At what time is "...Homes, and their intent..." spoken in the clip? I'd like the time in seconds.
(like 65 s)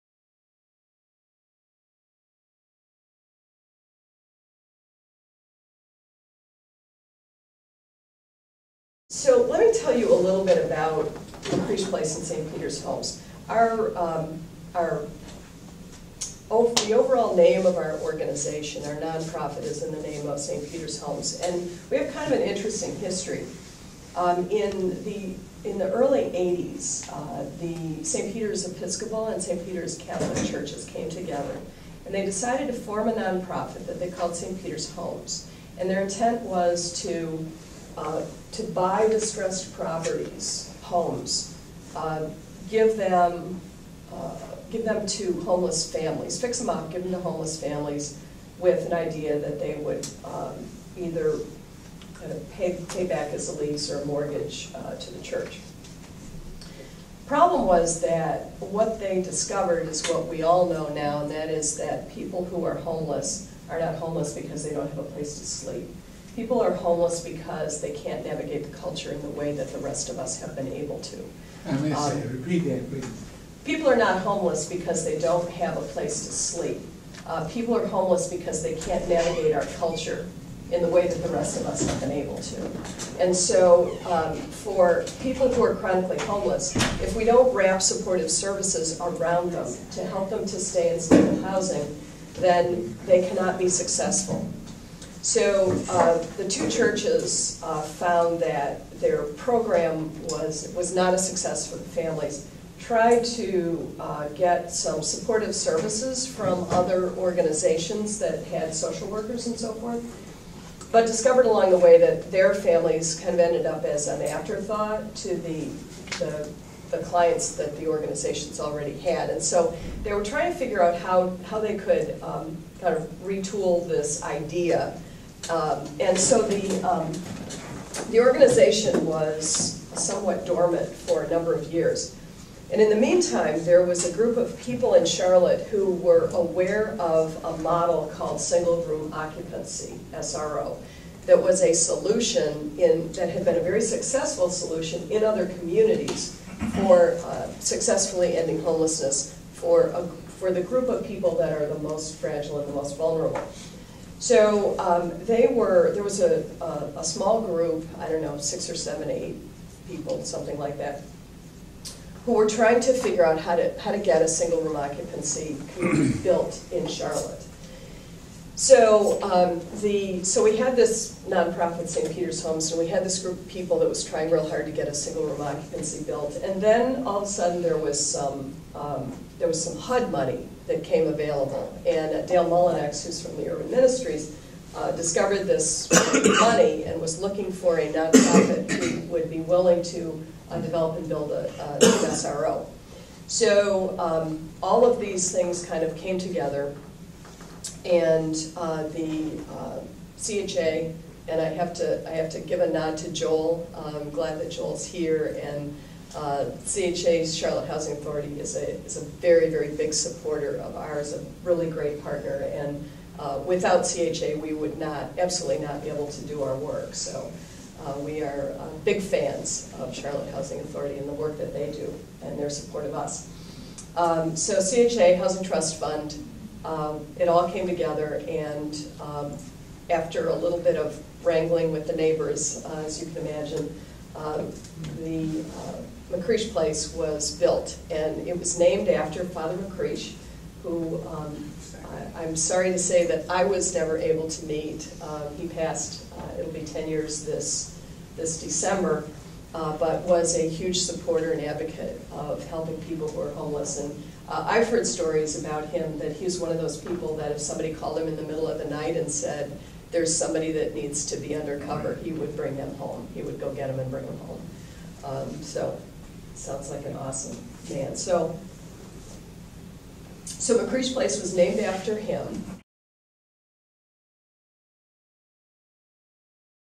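34 s.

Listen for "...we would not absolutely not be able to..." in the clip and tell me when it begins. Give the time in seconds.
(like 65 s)
214 s.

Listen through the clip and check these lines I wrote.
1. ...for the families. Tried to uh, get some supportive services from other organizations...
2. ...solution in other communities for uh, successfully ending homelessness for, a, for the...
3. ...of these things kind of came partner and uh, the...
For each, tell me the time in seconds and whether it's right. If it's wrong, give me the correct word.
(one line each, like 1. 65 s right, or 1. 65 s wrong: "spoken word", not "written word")
1. 101 s right
2. 144 s right
3. 194 s wrong: "together", not "partner".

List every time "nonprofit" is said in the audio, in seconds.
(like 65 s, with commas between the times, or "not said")
18 s, 33 s, 171 s, 187 s.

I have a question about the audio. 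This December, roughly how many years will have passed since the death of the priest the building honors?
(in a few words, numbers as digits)
10.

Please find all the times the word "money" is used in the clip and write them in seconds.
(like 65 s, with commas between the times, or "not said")
180 s, 186 s.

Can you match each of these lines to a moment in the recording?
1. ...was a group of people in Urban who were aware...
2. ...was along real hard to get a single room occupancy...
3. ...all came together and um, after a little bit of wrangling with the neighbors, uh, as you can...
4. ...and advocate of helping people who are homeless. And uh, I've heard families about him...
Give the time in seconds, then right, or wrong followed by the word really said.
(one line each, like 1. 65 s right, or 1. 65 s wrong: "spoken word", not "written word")
1. 133 s wrong: "Charlotte", not "Urban"
2. 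173 s wrong: "trying", not "along"
3. 227 s right
4. 251 s wrong: "stories", not "families".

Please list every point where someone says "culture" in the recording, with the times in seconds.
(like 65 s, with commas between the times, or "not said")
68 s, 79 s.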